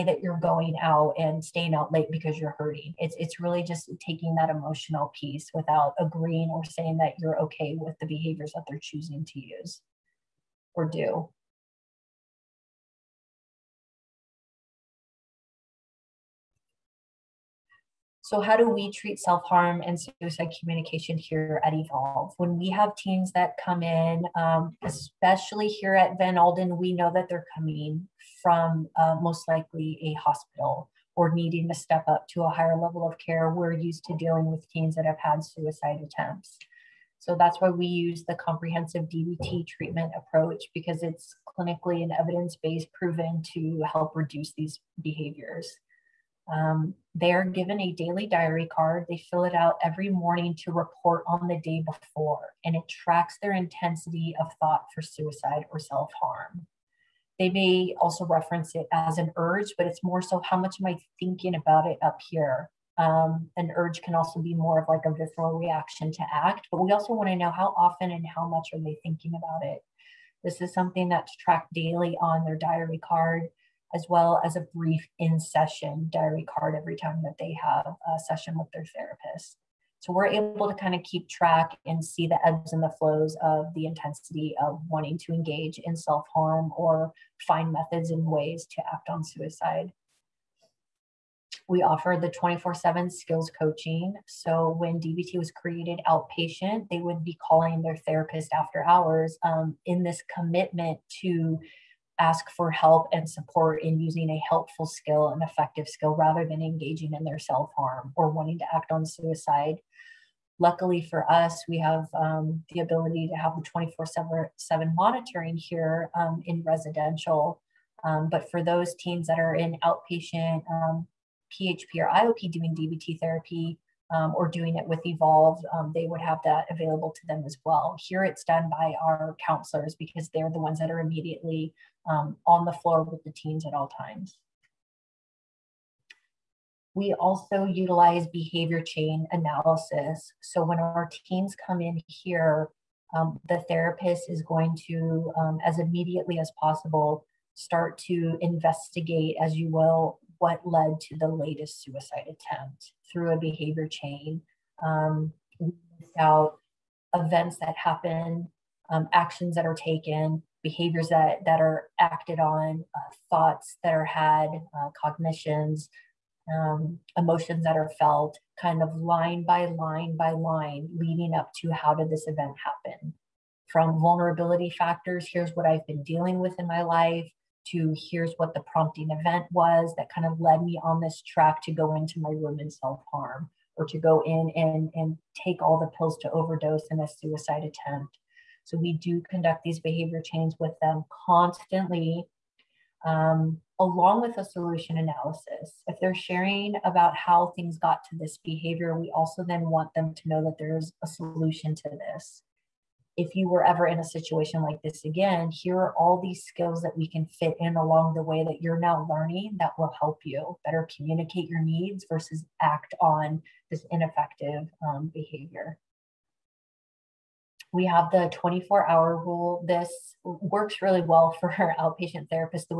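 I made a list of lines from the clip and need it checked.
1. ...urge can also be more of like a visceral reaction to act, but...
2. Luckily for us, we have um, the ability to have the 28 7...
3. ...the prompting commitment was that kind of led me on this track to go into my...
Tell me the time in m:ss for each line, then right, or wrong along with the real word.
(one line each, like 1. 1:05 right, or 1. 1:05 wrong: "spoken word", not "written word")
1. 1:03 right
2. 1:50 wrong: "24", not "28"
3. 2:58 wrong: "event", not "commitment".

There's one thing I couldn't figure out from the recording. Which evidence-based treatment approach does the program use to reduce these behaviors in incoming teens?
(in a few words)
comprehensive DBT.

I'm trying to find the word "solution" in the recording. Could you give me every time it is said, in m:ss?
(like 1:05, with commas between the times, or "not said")
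3:14, 3:21.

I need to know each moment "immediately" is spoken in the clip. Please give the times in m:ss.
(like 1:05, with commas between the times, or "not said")
2:10, 2:25.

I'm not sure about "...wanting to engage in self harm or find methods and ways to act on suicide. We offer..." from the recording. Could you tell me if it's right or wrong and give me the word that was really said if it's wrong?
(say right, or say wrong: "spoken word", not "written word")
right.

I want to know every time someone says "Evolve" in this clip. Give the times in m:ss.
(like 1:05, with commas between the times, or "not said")
0:21, 2:05.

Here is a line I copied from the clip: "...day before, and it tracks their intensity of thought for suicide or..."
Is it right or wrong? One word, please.
right.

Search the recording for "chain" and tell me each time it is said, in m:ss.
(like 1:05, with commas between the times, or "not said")
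2:18, 2:33, 3:10.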